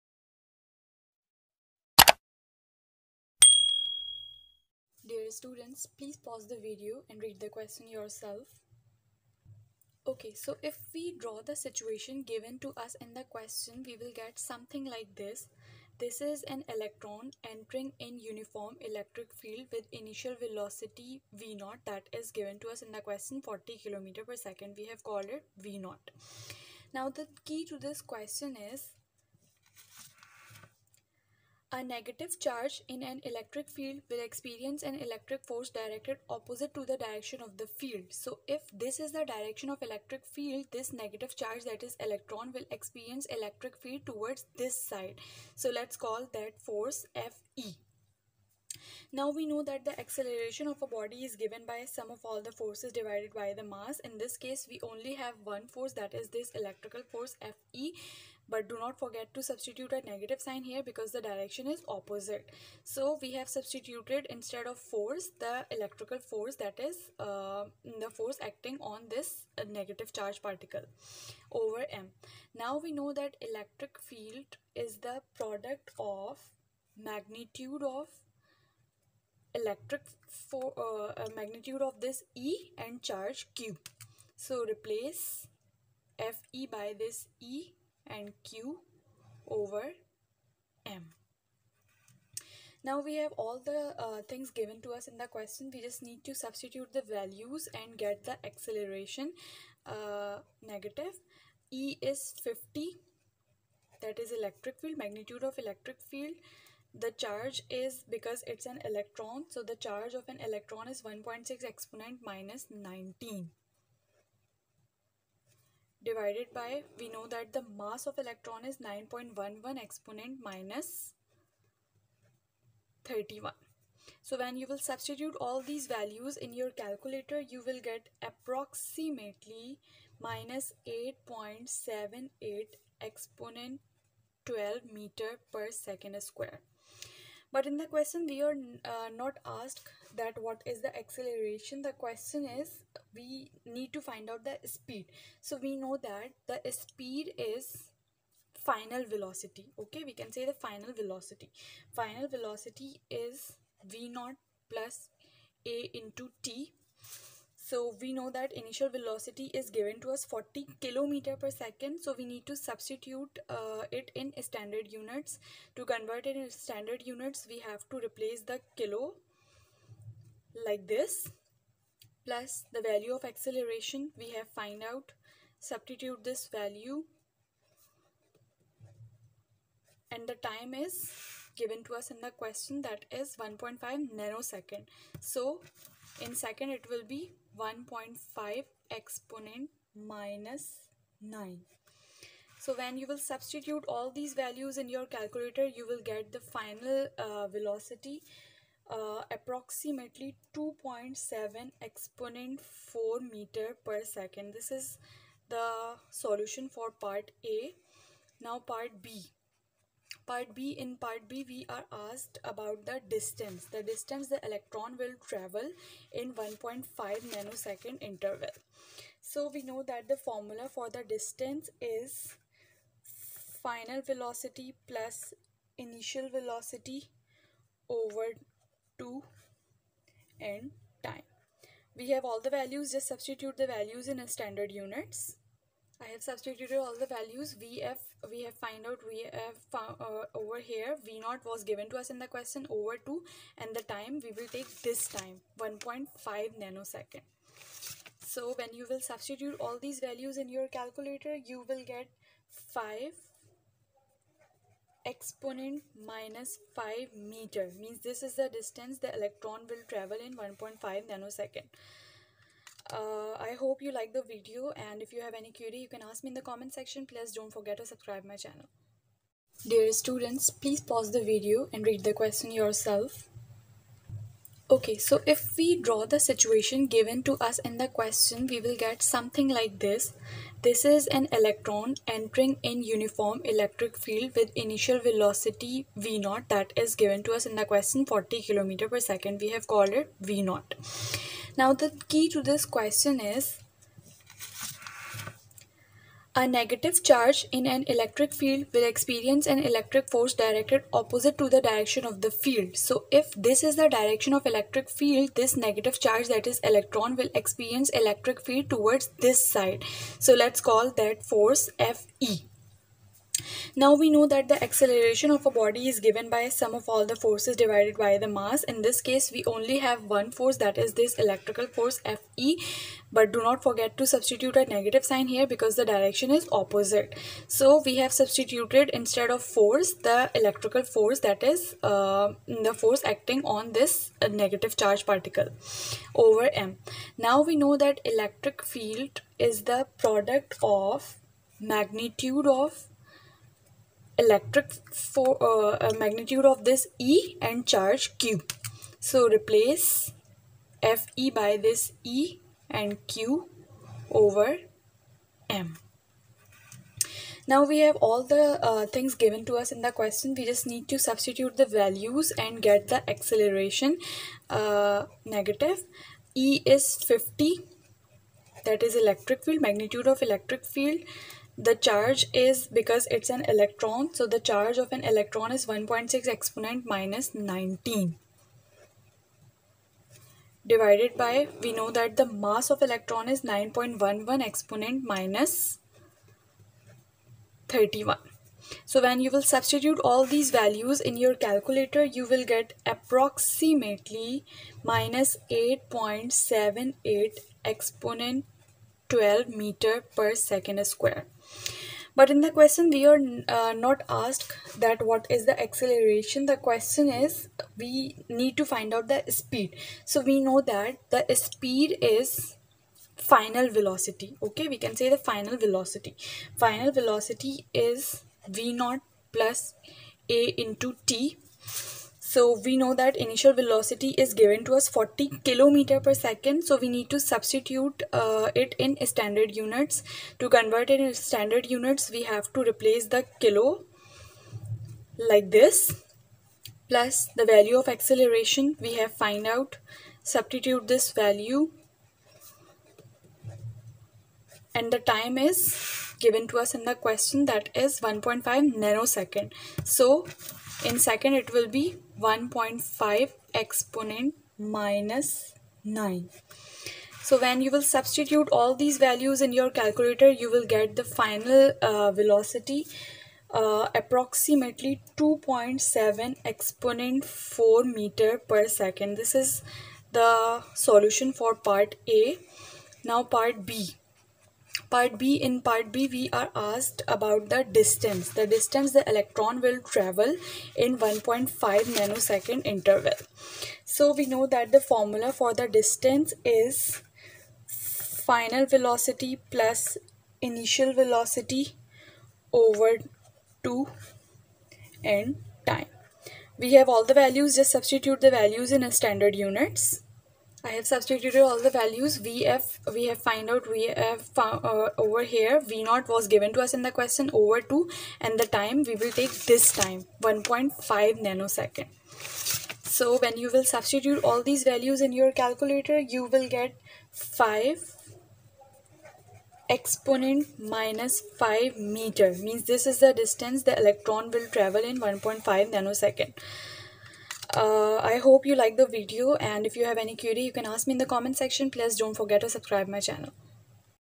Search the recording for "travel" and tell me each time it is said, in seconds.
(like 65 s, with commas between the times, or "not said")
215 s, 259 s, 479 s, 524 s.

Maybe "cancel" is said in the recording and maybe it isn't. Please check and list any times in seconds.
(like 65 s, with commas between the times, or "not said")
not said.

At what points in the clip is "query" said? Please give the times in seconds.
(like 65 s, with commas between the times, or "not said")
265 s, 530 s.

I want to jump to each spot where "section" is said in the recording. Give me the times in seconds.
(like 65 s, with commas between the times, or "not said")
266 s, 531 s.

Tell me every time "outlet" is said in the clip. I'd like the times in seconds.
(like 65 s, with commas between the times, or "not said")
not said.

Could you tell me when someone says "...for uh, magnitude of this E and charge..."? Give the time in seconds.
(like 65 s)
80 s.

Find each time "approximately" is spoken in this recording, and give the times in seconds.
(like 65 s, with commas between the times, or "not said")
128 s, 199 s, 392 s, 463 s.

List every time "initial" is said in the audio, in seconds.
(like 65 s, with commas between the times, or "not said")
19 s, 158 s, 225 s, 284 s, 423 s, 490 s.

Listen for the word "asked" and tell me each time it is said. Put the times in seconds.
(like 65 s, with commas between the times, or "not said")
139 s, 212 s, 404 s, 476 s.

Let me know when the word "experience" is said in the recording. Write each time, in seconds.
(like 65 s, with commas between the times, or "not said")
34 s, 42 s, 298 s, 307 s.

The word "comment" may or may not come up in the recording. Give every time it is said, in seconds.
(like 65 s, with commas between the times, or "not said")
266 s, 531 s.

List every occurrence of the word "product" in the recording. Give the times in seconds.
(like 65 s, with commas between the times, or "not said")
75 s, 339 s.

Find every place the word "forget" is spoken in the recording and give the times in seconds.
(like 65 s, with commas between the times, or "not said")
58 s, 267 s, 323 s, 532 s.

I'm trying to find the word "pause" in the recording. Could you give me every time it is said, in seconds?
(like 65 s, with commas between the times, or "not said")
6 s, 270 s.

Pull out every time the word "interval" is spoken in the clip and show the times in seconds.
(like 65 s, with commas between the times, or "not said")
218 s, 482 s.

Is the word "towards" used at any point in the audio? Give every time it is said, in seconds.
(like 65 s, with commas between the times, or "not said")
44 s, 308 s.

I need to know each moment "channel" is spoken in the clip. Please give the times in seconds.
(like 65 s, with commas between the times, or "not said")
268 s, 533 s.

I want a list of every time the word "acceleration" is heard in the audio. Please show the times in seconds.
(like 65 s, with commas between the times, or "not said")
49 s, 98 s, 140 s, 173 s, 314 s, 363 s, 405 s, 437 s.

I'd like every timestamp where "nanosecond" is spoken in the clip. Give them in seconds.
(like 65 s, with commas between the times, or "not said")
184 s, 216 s, 246 s, 261 s, 448 s, 481 s, 511 s, 525 s.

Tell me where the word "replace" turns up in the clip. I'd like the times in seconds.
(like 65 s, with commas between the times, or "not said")
84 s, 168 s, 349 s, 432 s.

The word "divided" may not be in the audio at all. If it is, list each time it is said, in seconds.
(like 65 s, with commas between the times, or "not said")
52 s, 116 s, 317 s, 380 s.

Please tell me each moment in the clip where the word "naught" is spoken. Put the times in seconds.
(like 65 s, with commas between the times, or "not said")
154 s, 418 s.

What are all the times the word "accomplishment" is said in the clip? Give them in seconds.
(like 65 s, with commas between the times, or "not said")
not said.